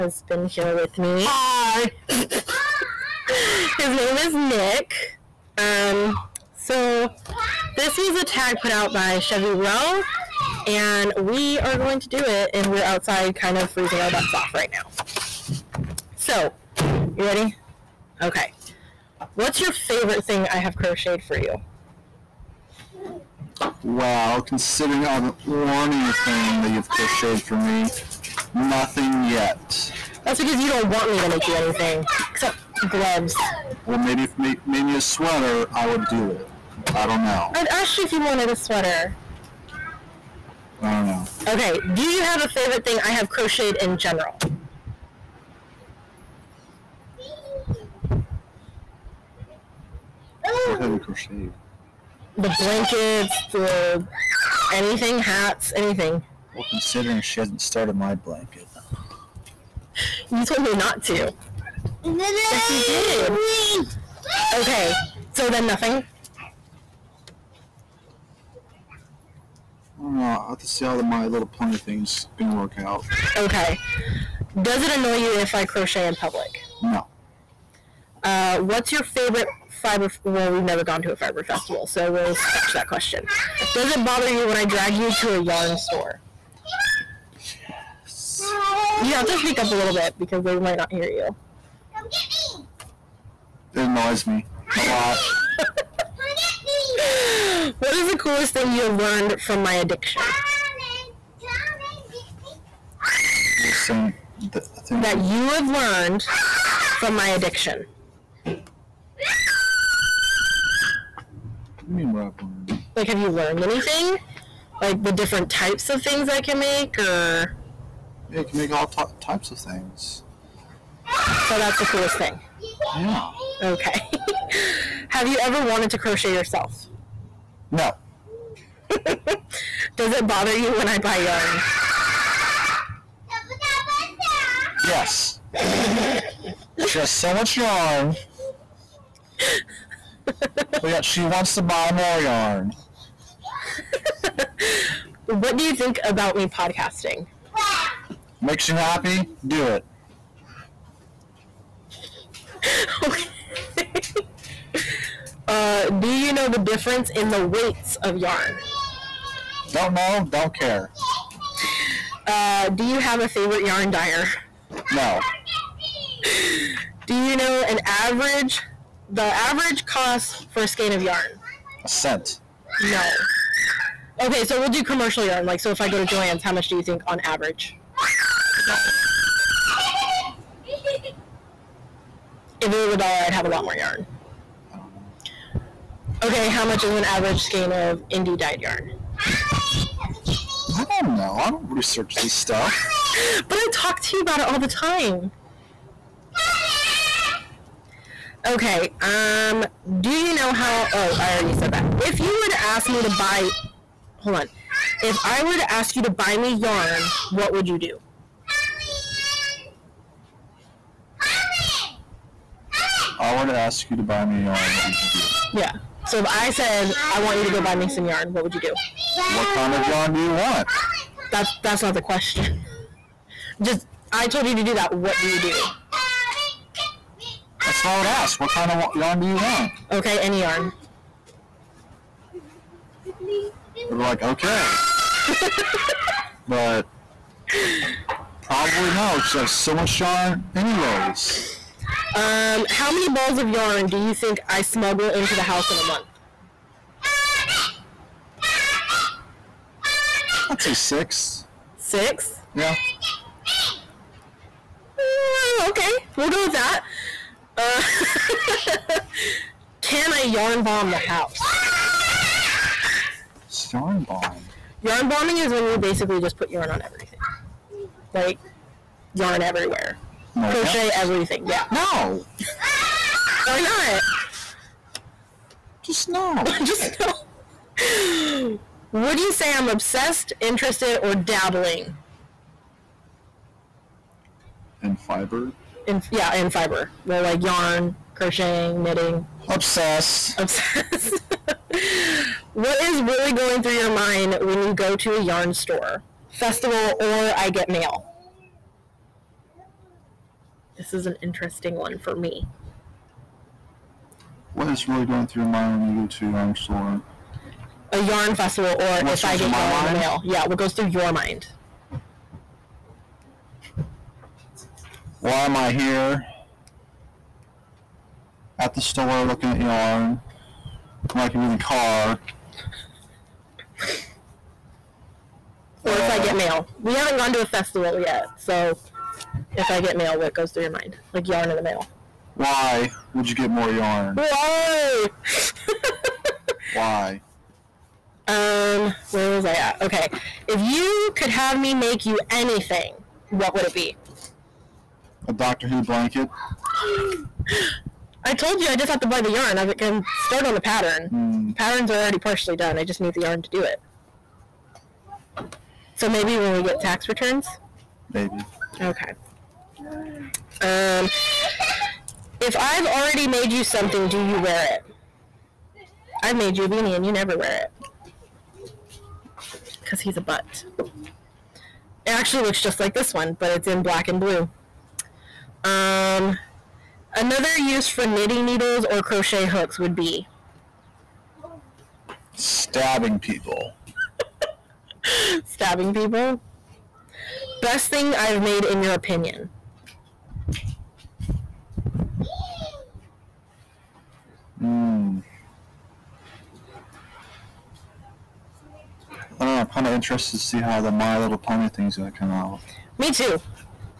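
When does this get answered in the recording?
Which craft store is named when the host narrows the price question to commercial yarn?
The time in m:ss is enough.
2:56.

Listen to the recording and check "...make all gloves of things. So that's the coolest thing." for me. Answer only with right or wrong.
wrong.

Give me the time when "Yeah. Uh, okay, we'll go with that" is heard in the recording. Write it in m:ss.
4:12.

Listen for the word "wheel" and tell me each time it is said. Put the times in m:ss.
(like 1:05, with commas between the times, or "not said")
not said.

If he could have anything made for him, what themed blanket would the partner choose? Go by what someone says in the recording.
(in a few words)
Doctor Who blanket.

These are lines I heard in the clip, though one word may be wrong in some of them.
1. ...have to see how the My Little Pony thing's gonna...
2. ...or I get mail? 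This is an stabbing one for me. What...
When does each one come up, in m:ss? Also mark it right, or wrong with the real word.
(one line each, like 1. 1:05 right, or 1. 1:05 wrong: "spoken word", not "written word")
1. 1:10 right
2. 4:56 wrong: "interesting", not "stabbing".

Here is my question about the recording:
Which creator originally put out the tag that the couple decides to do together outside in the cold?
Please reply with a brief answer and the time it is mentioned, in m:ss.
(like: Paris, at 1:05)
Chevy Rowe, at 0:09.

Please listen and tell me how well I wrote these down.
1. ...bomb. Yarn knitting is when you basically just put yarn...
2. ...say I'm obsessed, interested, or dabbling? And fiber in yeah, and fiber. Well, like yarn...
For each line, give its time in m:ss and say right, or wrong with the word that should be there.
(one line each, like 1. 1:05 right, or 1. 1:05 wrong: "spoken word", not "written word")
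1. 4:24 wrong: "bombing", not "knitting"
2. 4:39 right.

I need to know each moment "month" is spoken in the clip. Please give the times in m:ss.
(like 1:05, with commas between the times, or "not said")
4:05.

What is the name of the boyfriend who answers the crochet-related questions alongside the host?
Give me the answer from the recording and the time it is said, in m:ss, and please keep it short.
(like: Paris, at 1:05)
Nick, at 0:03.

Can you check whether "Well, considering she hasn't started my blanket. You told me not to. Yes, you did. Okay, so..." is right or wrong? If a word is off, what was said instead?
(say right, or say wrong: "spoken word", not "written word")
right.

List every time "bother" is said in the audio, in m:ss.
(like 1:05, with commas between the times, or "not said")
1:24, 2:10.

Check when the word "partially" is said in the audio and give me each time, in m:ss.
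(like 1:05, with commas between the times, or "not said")
5:52.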